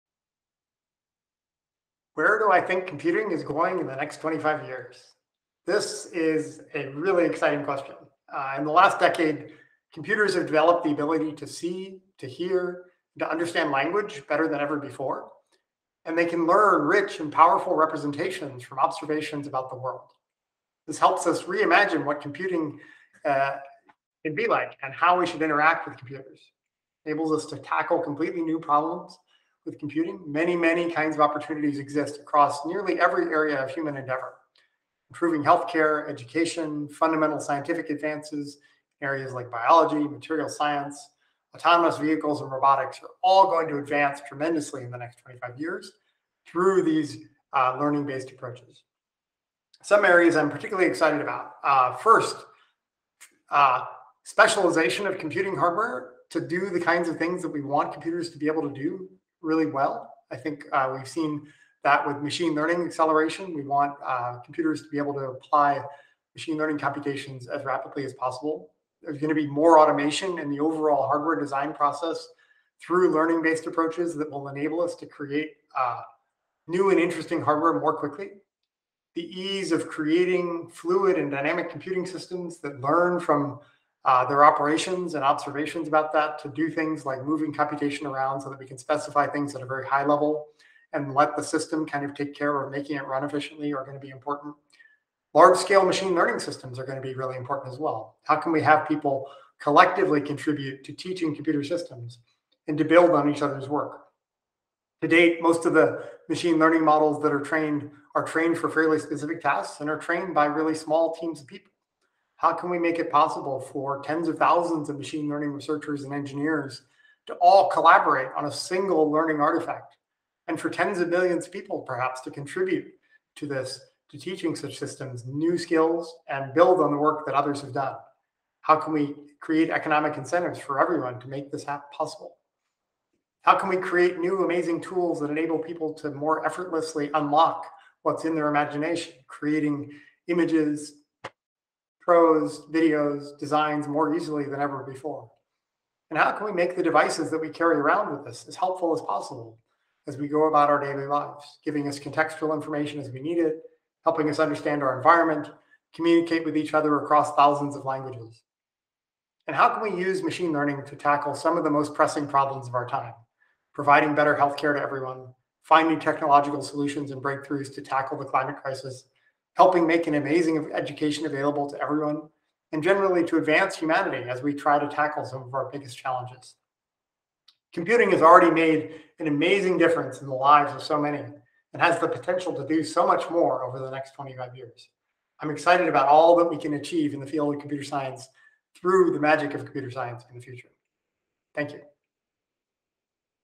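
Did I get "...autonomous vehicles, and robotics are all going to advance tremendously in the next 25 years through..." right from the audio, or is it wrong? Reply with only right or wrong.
right.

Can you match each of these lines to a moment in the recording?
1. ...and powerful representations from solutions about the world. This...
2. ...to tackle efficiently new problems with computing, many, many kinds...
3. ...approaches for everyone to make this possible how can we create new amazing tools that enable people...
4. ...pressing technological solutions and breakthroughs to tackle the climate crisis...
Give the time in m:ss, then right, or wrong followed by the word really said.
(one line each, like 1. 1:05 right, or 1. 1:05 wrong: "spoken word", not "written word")
1. 0:17 wrong: "observations", not "solutions"
2. 0:27 wrong: "completely", not "efficiently"
3. 2:10 wrong: "incentives", not "approaches"
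4. 2:45 wrong: "finding", not "pressing".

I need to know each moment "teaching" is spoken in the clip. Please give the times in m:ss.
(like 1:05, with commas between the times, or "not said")
1:40, 2:04.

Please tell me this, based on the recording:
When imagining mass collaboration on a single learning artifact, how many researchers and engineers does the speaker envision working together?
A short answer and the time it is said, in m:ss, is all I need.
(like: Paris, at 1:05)
tens of thousands, at 1:54.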